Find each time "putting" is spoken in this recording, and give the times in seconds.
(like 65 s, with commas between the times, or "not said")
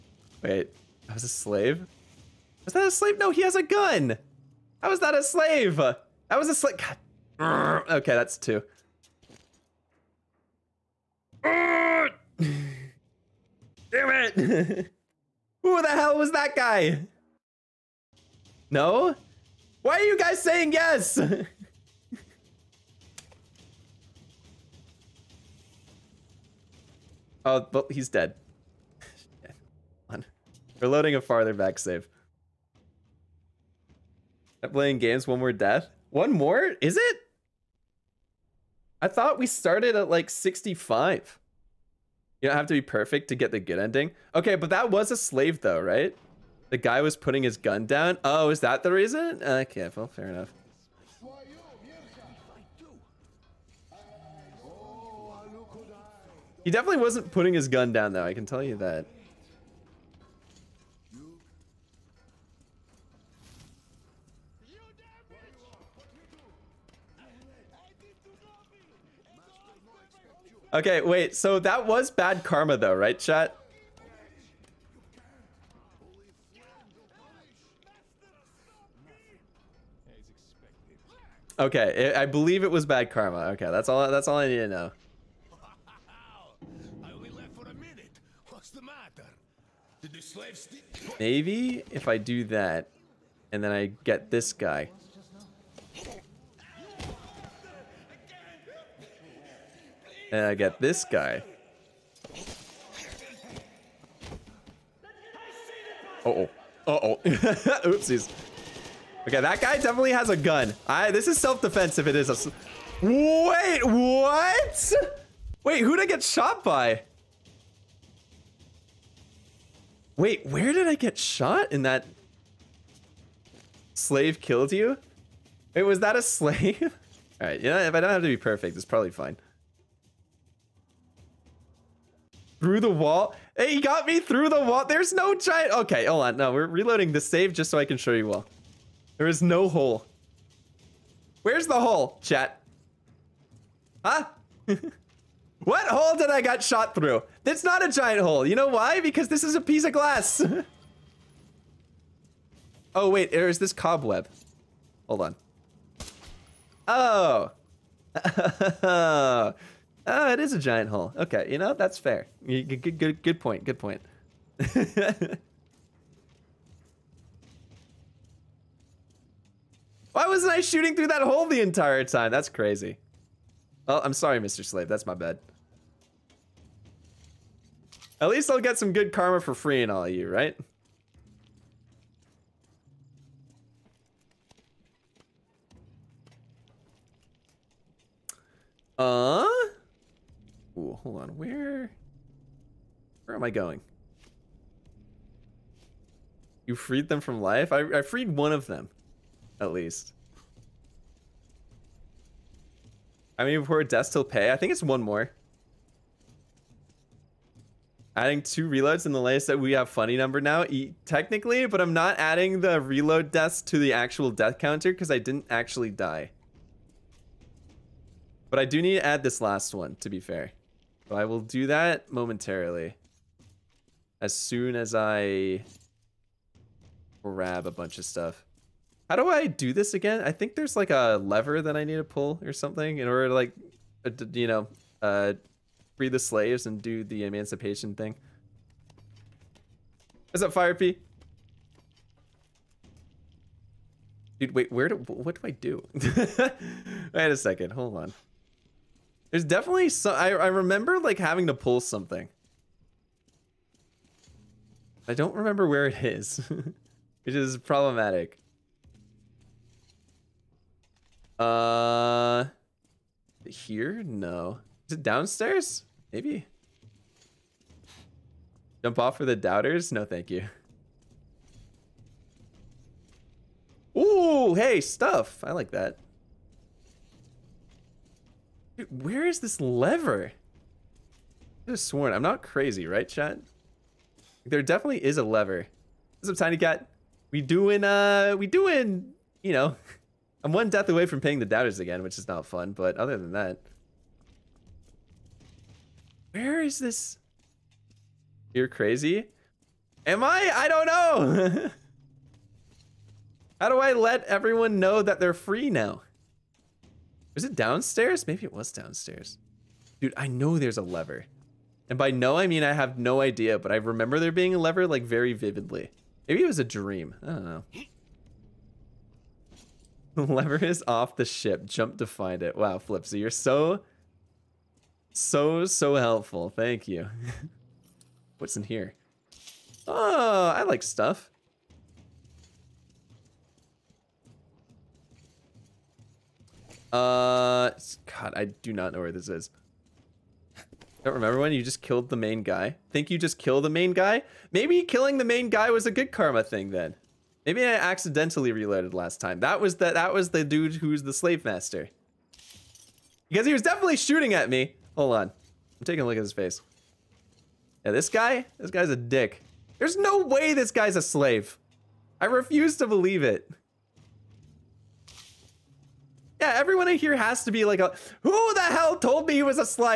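47 s, 57 s.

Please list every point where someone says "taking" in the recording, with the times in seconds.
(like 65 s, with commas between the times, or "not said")
355 s.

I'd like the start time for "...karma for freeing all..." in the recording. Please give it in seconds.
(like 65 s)
179 s.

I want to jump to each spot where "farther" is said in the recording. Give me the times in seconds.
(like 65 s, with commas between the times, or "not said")
31 s.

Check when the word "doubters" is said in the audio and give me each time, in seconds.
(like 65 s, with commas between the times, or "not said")
269 s, 291 s.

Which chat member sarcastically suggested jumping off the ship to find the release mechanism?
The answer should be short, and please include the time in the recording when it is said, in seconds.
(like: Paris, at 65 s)
Flipsy, at 322 s.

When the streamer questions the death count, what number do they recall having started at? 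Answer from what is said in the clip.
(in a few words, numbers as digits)
65.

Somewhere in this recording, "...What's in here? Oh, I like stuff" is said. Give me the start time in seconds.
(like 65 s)
328 s.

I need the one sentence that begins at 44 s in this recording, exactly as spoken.
Okay, but that was a slave though, right?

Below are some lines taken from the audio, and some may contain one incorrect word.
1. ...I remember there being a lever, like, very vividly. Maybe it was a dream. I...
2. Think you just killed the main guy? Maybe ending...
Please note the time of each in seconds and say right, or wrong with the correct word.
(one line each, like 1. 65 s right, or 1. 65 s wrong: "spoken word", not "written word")
1. 313 s right
2. 342 s wrong: "killing", not "ending".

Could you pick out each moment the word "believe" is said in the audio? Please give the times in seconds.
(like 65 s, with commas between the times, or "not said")
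82 s, 362 s.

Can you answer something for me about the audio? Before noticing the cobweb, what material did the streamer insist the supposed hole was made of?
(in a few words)
glass.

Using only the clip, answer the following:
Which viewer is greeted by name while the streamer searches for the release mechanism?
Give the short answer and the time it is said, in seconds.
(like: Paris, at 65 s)
Tiny Cat, at 286 s.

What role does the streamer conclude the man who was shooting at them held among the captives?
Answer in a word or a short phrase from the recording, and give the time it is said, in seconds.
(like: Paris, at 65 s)
slave master, at 351 s.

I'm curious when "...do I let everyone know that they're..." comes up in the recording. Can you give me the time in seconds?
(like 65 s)
303 s.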